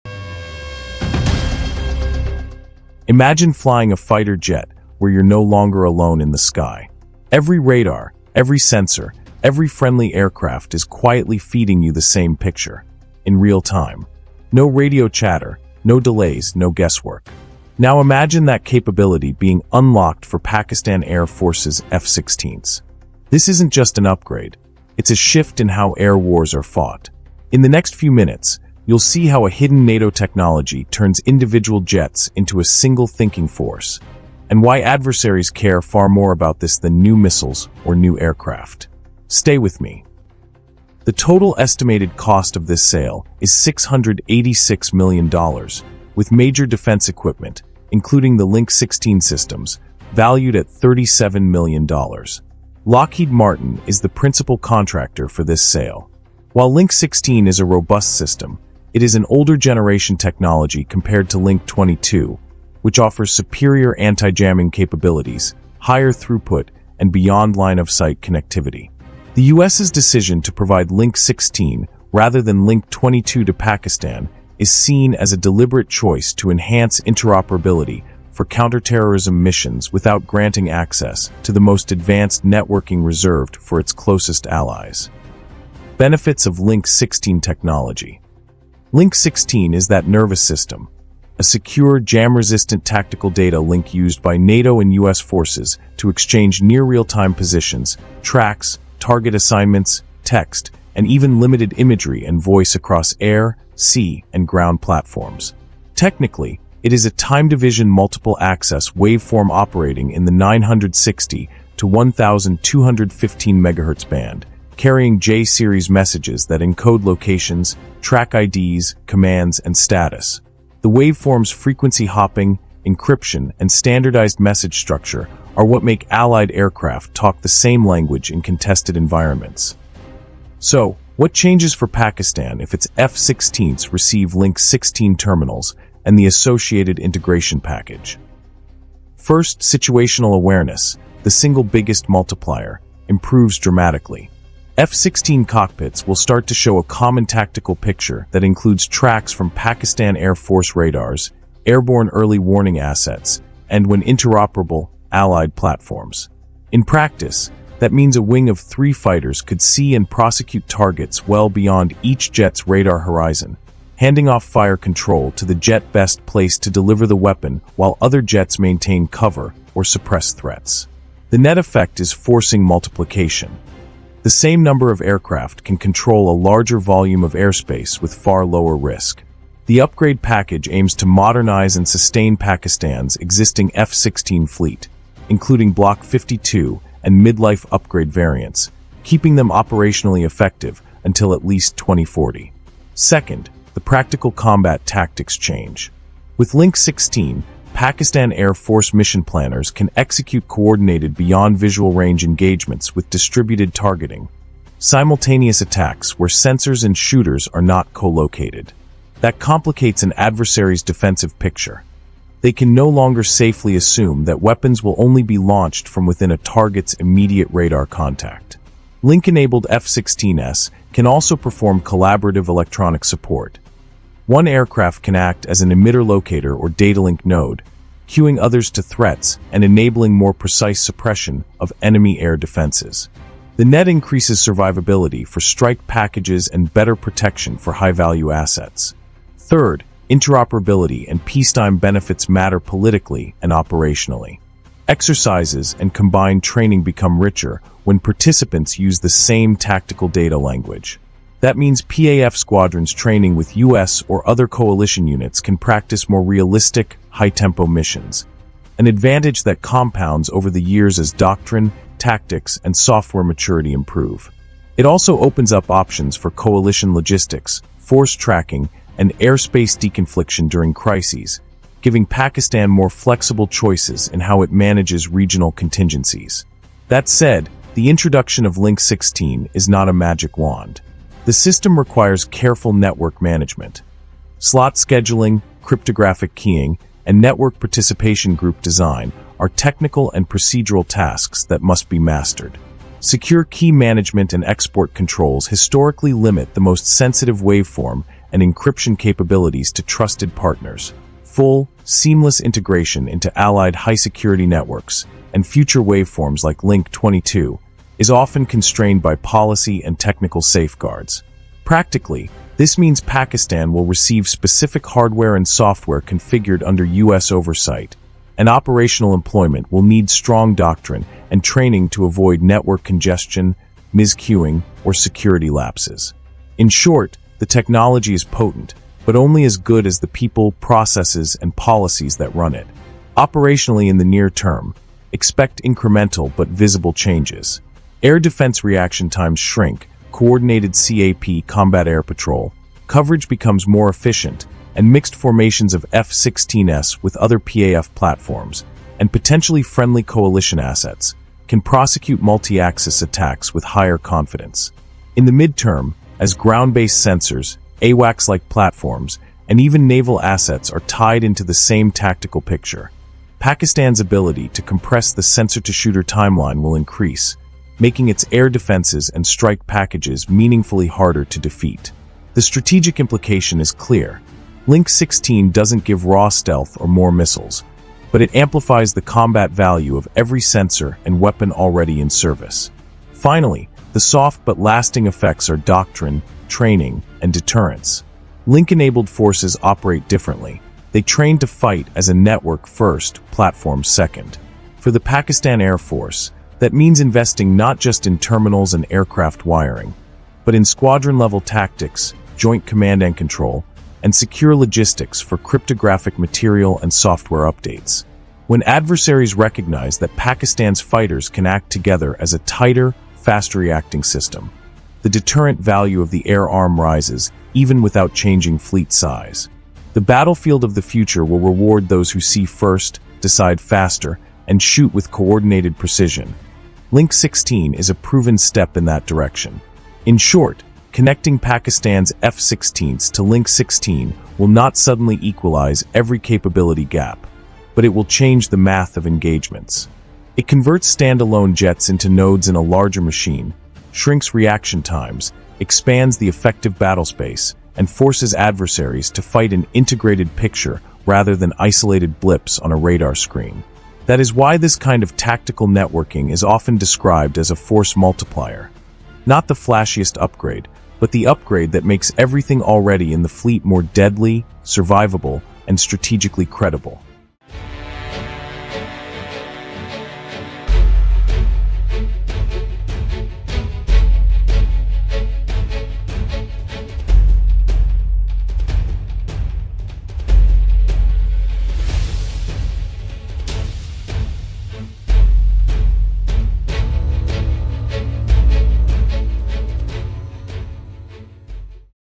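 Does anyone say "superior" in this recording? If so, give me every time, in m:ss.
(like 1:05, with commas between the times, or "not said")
1:03.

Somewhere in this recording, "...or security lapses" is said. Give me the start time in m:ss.
5:24.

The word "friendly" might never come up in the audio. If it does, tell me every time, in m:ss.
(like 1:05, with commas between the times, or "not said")
0:09, 5:49.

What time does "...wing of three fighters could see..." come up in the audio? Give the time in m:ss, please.
2:38.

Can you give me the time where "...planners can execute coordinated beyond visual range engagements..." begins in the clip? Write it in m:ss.
3:19.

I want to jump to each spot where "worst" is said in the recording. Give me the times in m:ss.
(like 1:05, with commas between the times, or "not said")
not said.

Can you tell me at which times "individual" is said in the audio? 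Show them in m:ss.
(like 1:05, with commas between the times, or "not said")
0:31.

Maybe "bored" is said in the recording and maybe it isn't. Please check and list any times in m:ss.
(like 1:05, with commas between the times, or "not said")
not said.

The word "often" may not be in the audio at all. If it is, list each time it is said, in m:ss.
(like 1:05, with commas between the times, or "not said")
5:08, 7:36.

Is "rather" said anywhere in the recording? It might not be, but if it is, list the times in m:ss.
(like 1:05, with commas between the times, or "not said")
1:12, 7:31.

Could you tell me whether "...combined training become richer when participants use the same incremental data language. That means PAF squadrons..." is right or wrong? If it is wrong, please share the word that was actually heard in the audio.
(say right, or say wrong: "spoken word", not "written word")
wrong: "tactical", not "incremental".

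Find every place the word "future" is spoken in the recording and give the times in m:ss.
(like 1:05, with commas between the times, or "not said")
5:05, 7:00.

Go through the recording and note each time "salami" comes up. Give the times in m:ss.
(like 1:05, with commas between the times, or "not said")
not said.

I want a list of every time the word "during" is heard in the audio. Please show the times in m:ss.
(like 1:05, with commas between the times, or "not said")
4:30.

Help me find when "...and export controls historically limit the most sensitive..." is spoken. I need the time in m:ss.
4:54.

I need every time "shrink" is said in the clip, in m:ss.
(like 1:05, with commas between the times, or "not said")
5:39, 7:23.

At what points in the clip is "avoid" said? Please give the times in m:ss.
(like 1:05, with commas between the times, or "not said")
5:22.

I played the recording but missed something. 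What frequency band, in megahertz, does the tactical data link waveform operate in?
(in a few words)
960 to 1215 MHz.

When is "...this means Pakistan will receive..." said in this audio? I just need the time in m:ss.
5:12.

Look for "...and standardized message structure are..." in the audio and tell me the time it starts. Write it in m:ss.
2:03.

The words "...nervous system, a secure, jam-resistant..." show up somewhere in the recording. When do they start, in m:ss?
1:30.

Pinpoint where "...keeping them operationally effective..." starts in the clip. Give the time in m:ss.
3:09.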